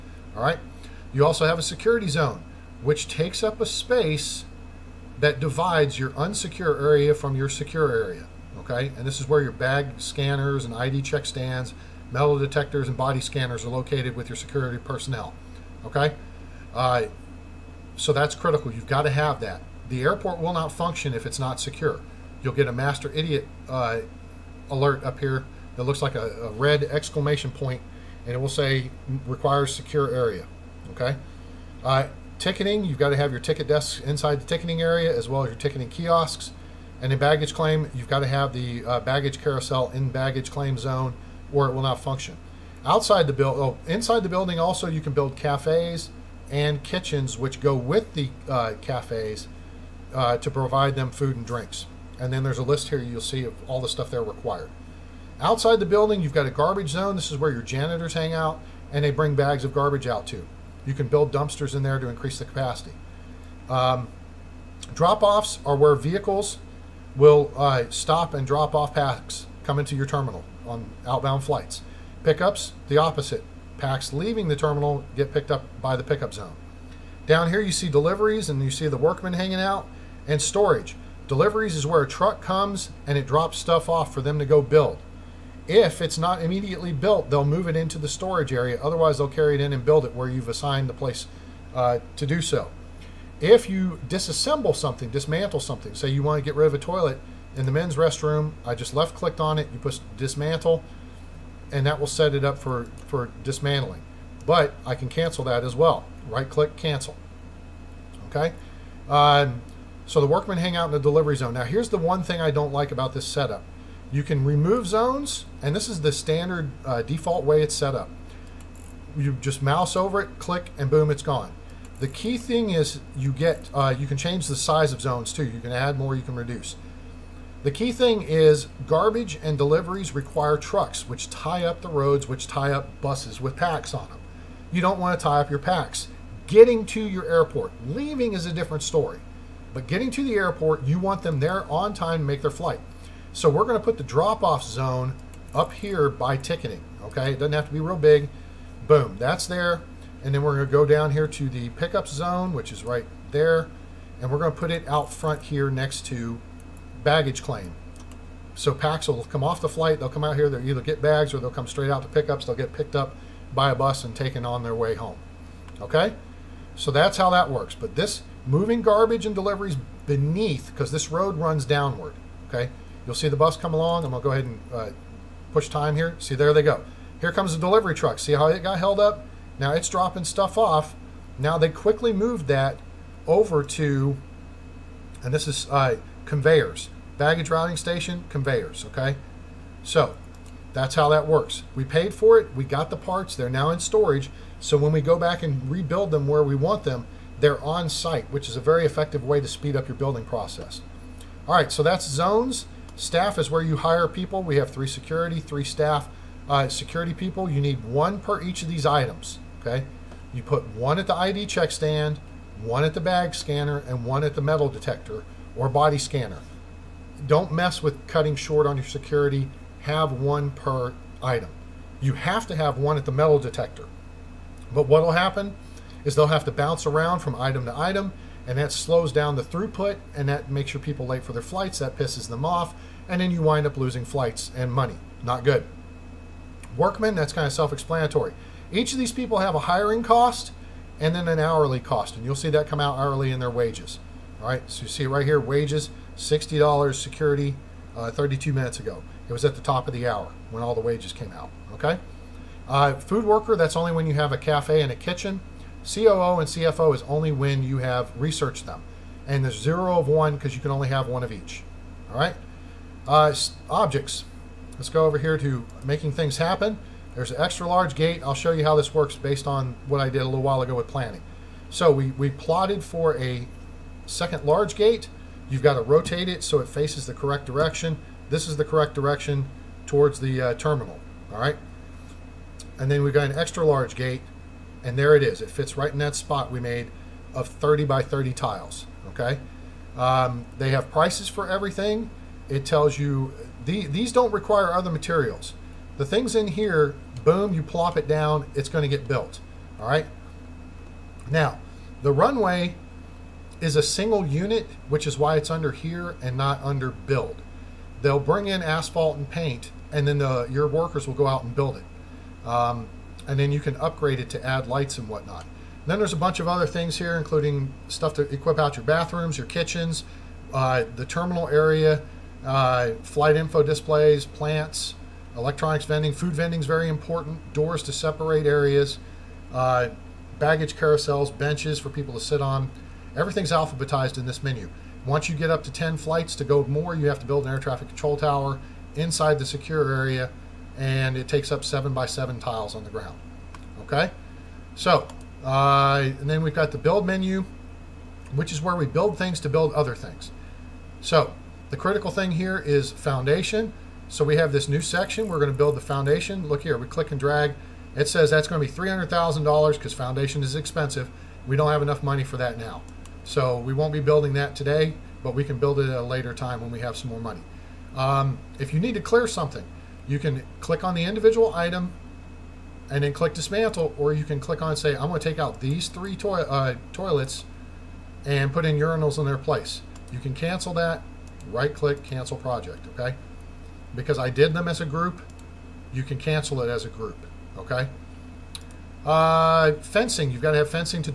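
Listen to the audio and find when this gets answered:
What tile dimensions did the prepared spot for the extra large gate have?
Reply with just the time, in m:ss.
4:47.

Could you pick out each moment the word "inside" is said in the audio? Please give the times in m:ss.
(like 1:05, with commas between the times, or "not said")
0:34, 0:43, 5:38.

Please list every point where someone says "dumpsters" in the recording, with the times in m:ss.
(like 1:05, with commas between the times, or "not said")
1:01.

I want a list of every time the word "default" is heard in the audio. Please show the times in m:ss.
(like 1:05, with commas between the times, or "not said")
1:57.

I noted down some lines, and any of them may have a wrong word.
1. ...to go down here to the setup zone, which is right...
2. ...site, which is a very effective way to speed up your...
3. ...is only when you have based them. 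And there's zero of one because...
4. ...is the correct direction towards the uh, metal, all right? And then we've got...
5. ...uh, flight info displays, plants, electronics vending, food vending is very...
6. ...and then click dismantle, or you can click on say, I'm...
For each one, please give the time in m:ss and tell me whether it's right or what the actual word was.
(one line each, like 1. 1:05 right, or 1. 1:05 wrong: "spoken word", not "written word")
1. 2:30 wrong: "pickup", not "setup"
2. 3:17 right
3. 4:16 wrong: "researched", not "based"
4. 4:38 wrong: "terminal", not "metal"
5. 5:22 right
6. 6:12 right.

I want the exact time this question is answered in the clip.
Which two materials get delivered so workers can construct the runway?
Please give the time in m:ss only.
5:08.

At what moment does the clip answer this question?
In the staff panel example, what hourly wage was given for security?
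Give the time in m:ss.
4:06.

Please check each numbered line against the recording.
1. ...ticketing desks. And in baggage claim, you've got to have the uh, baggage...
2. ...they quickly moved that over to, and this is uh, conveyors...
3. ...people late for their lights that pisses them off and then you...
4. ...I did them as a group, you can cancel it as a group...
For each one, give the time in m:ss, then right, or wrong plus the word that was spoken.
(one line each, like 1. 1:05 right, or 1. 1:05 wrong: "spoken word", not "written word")
1. 0:35 wrong: "kiosks", not "desks"
2. 3:01 right
3. 3:50 wrong: "flights", not "lights"
4. 6:24 right.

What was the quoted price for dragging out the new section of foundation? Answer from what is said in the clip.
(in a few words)
$300,000.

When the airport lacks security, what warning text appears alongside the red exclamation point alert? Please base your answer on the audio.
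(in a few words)
Requires secure area.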